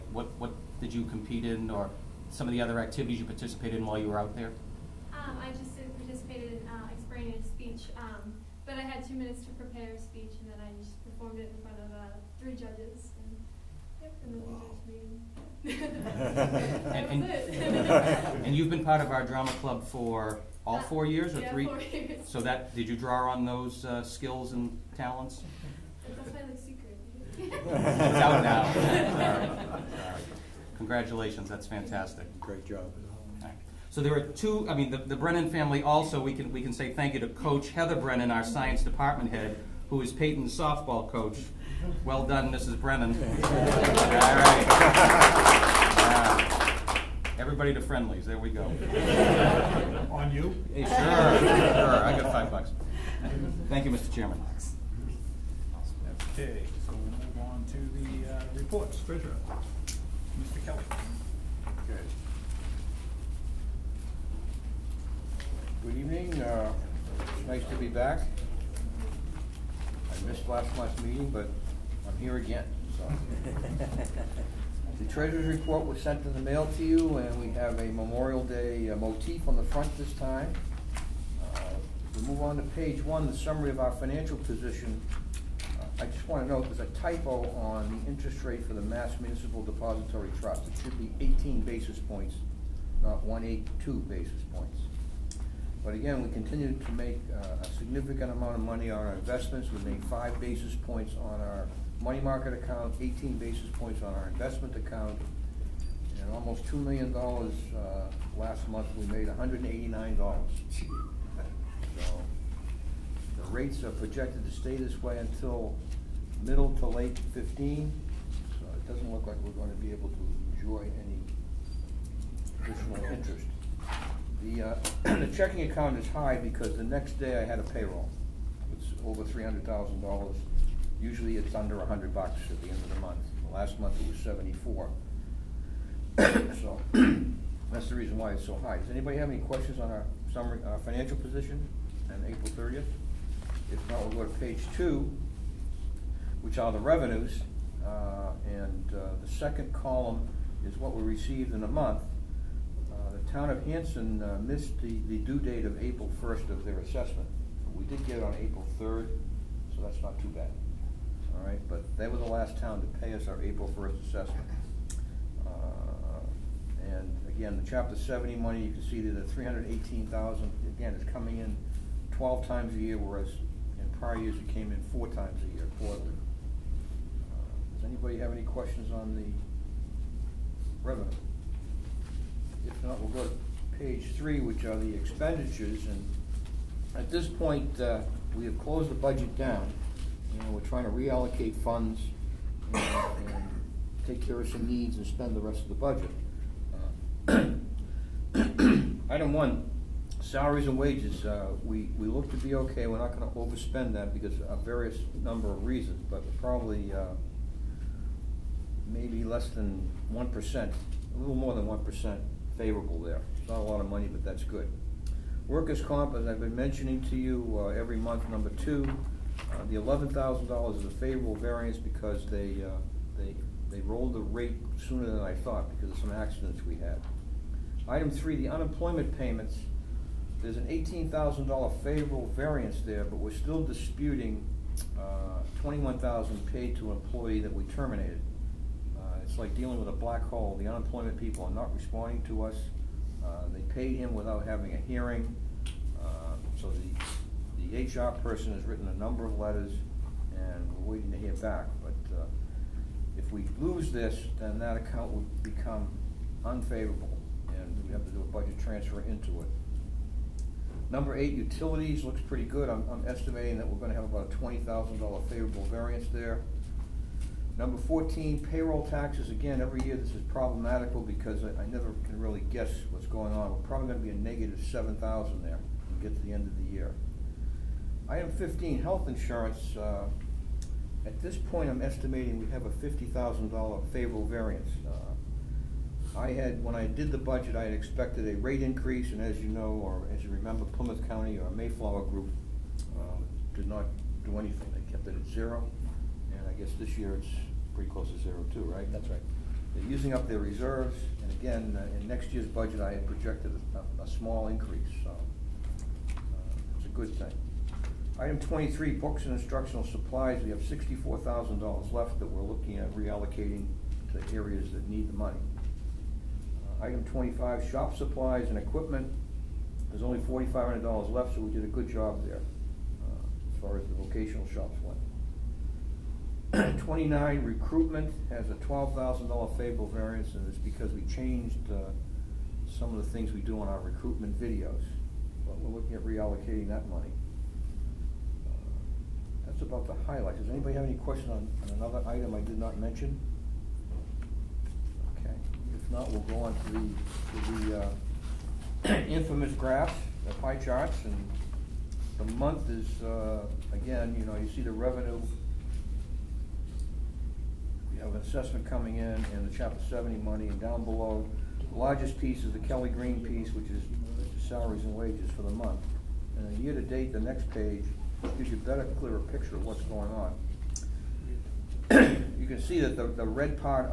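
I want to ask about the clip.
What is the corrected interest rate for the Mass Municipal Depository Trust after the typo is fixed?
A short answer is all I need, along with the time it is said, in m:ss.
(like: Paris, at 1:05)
18 basis points, at 1:31.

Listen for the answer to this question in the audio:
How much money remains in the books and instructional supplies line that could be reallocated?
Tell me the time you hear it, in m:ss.
5:10.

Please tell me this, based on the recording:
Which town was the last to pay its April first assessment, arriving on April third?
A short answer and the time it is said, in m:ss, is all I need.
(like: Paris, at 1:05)
Hanson, at 2:33.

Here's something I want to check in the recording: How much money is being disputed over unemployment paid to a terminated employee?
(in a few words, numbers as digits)
21,000.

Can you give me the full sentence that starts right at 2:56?
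Uh, Does anybody have any questions on the revenue?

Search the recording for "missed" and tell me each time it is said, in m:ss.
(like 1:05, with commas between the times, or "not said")
1:10, 2:34.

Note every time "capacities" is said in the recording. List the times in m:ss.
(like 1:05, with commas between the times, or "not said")
not said.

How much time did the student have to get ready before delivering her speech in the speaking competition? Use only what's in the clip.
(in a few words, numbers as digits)
2 minutes.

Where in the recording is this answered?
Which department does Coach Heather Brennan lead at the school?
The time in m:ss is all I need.
0:38.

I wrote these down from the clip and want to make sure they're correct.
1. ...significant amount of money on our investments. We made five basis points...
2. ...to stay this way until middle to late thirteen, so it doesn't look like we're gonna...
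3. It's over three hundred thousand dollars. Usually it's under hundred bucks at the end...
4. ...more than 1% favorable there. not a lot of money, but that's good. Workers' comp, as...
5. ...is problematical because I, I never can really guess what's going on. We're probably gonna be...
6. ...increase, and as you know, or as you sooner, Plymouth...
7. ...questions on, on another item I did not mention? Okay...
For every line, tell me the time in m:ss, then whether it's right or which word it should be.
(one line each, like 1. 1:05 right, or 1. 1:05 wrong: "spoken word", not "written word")
1. 1:37 right
2. 1:54 wrong: "fifteen", not "thirteen"
3. 2:08 right
4. 3:31 right
5. 4:30 right
6. 4:48 wrong: "remember", not "sooner"
7. 5:40 right.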